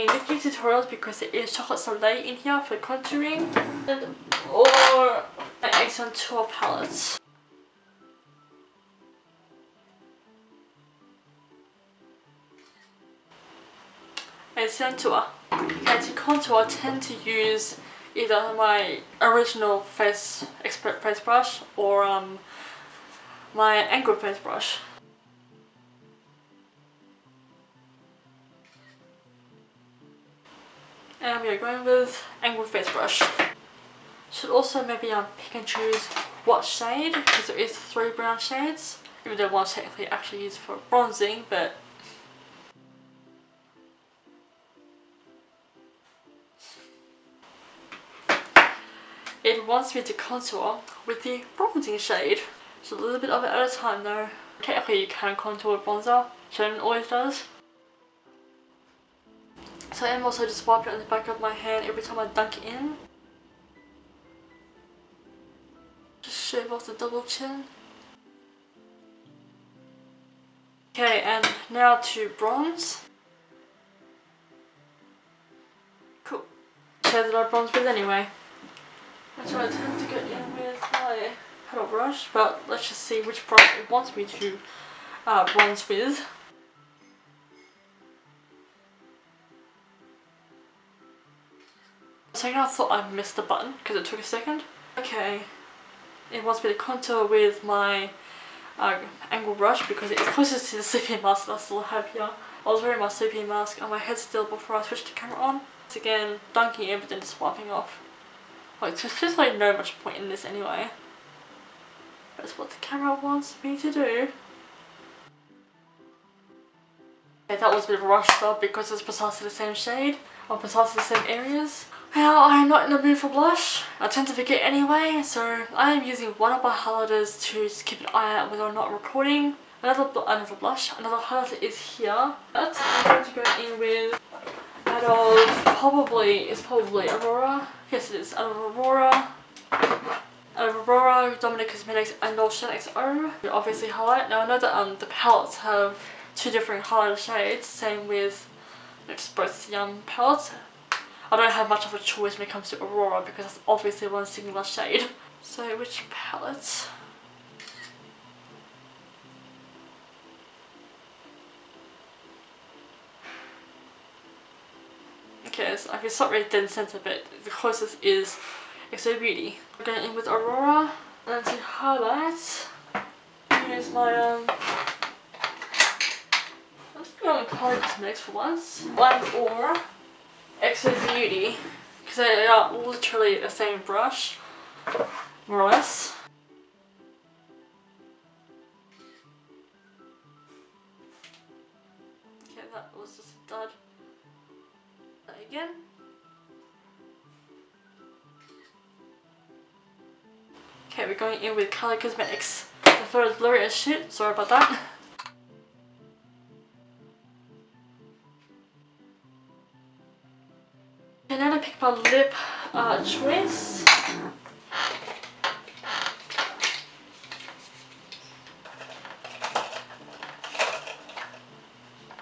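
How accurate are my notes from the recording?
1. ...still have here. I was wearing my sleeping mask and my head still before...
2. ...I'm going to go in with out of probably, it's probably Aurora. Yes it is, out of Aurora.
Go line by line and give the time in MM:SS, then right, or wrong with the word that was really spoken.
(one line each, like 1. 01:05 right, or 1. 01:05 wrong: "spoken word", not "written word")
1. 01:41 right
2. 02:13 right.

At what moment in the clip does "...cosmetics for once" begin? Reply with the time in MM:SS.
02:57.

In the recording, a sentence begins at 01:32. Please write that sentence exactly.
second I thought I missed the button because it took a second.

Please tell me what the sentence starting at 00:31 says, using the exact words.
And we are going with angled face brush.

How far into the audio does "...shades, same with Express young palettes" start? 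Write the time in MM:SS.
02:27.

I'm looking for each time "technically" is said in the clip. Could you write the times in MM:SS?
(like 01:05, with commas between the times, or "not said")
00:39, 00:54.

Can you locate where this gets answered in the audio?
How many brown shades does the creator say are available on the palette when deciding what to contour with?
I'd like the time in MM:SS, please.
00:37.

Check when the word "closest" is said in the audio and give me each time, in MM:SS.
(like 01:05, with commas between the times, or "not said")
01:40, 02:47.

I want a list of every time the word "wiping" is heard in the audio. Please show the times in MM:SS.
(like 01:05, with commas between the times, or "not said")
01:00, 01:47.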